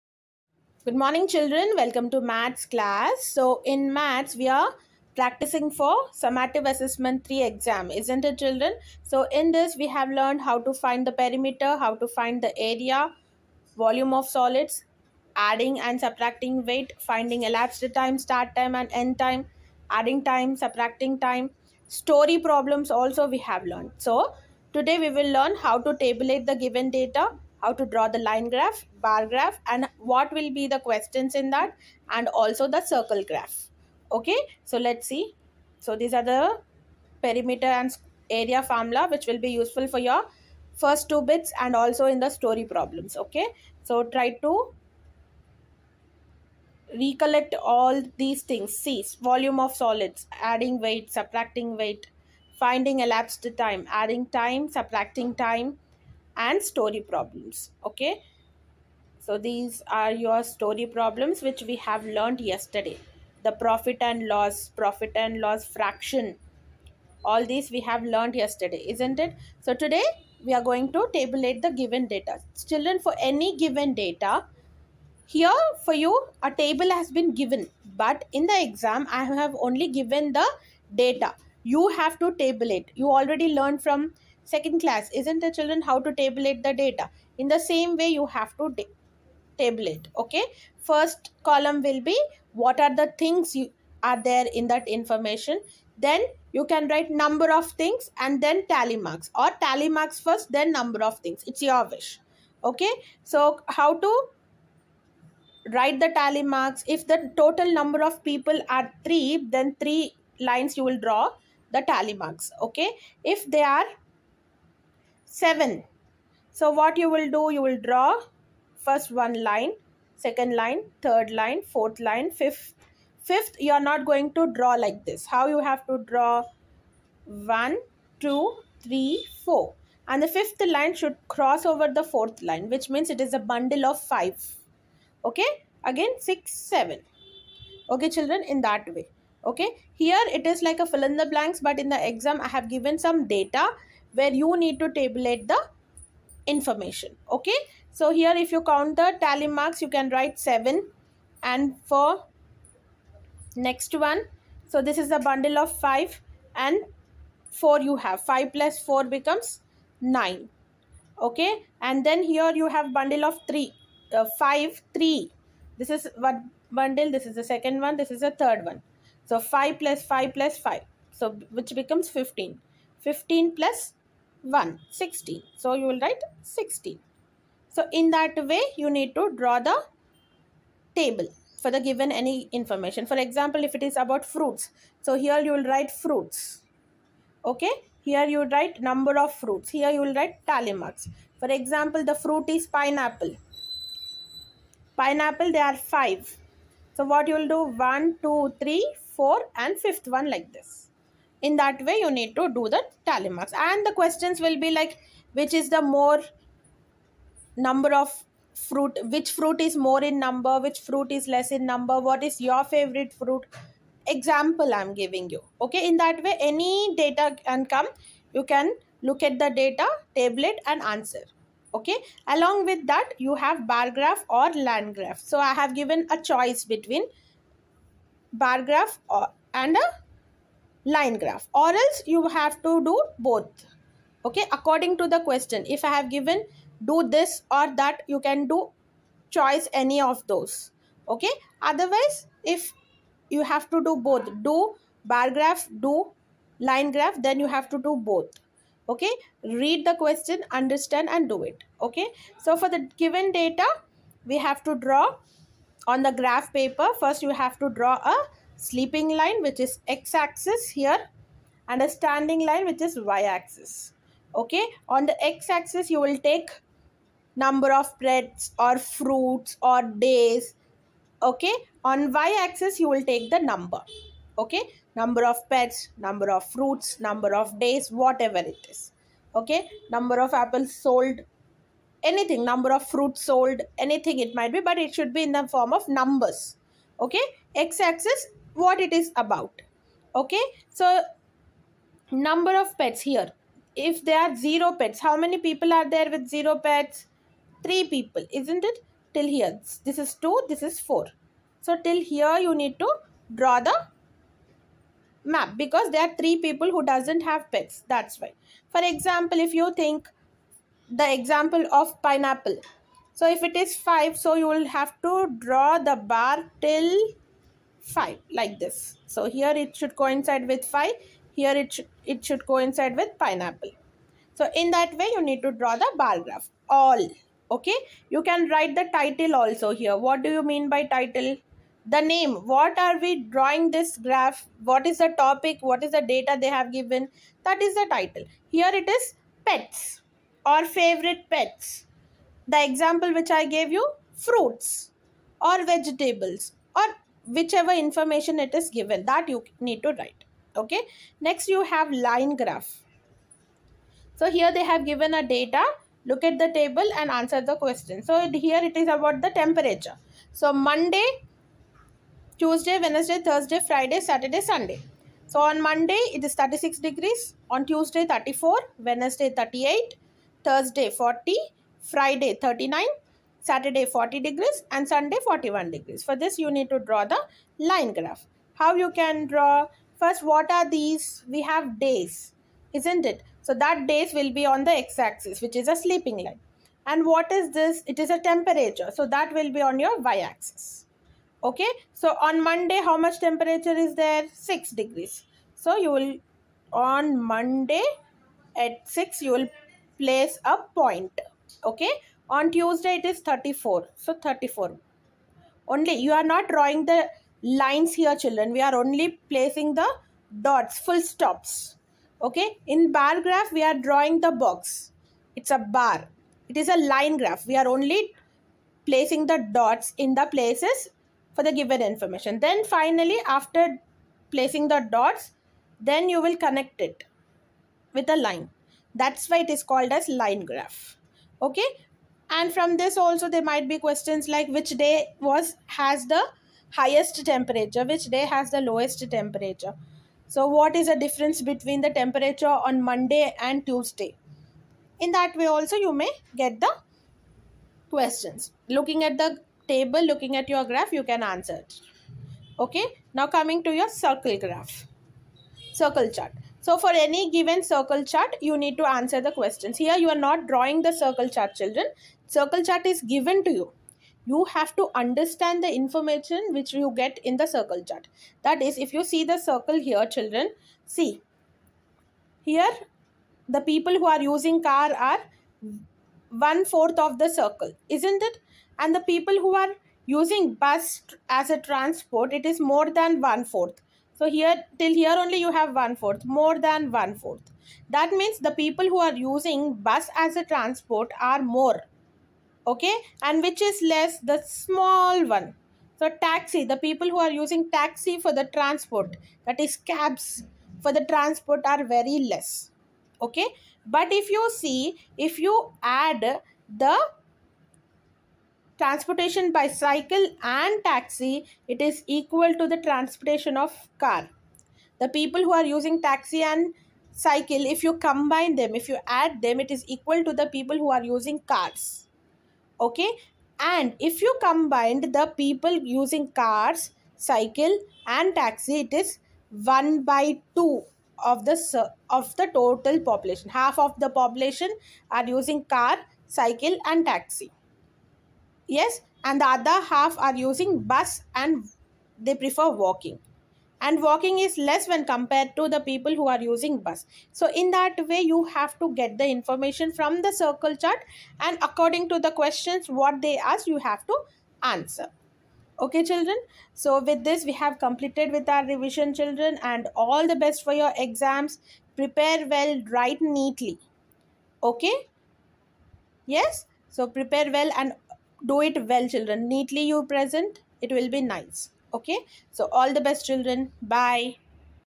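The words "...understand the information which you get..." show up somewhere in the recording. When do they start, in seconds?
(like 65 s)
464 s.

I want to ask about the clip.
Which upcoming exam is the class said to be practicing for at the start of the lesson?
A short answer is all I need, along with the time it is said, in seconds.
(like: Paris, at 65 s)
Summative assessment 3, at 6 s.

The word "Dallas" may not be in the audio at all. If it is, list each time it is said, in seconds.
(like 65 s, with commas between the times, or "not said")
not said.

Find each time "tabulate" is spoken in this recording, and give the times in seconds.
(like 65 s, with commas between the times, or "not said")
26 s, 71 s, 86 s, 144 s.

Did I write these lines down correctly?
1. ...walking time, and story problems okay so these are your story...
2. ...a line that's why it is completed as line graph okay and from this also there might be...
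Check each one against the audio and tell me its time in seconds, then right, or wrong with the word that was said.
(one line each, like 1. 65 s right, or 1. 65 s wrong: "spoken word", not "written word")
1. 54 s wrong: "subtracting", not "walking"
2. 428 s wrong: "called", not "completed".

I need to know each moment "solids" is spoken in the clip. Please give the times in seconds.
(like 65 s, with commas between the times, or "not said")
14 s, 49 s.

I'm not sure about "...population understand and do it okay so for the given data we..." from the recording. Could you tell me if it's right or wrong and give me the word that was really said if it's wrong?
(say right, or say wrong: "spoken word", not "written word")
wrong: "question", not "population".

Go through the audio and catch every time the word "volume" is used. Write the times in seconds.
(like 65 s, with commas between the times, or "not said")
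13 s, 49 s.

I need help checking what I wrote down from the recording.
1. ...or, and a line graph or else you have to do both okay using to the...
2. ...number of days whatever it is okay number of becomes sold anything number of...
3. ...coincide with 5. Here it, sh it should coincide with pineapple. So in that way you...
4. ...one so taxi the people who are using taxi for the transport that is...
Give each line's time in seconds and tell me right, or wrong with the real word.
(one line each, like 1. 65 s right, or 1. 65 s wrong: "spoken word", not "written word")
1. 229 s wrong: "according", not "using"
2. 276 s wrong: "apples", not "becomes"
3. 319 s right
4. 495 s right.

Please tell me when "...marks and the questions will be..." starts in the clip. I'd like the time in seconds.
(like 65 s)
203 s.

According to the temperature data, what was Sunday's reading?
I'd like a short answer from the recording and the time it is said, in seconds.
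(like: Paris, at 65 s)
41 degrees, at 375 s.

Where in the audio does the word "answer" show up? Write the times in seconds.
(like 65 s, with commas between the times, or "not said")
220 s, 357 s, 451 s, 458 s, 554 s.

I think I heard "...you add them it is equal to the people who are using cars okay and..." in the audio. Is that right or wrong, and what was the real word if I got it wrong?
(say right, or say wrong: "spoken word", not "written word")
right.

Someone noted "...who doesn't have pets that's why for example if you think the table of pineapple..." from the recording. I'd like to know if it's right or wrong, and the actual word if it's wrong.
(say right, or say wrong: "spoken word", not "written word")
wrong: "example", not "table".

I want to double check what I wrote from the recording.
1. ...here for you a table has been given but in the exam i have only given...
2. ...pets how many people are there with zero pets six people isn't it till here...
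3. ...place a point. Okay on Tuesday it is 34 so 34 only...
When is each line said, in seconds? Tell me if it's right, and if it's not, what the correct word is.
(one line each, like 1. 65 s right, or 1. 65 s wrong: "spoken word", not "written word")
1. 75 s right
2. 294 s wrong: "three", not "six"
3. 399 s right.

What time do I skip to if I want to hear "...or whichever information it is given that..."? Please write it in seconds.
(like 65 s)
346 s.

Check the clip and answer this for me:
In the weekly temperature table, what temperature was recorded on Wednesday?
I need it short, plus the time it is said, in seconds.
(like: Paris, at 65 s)
38 degrees, at 369 s.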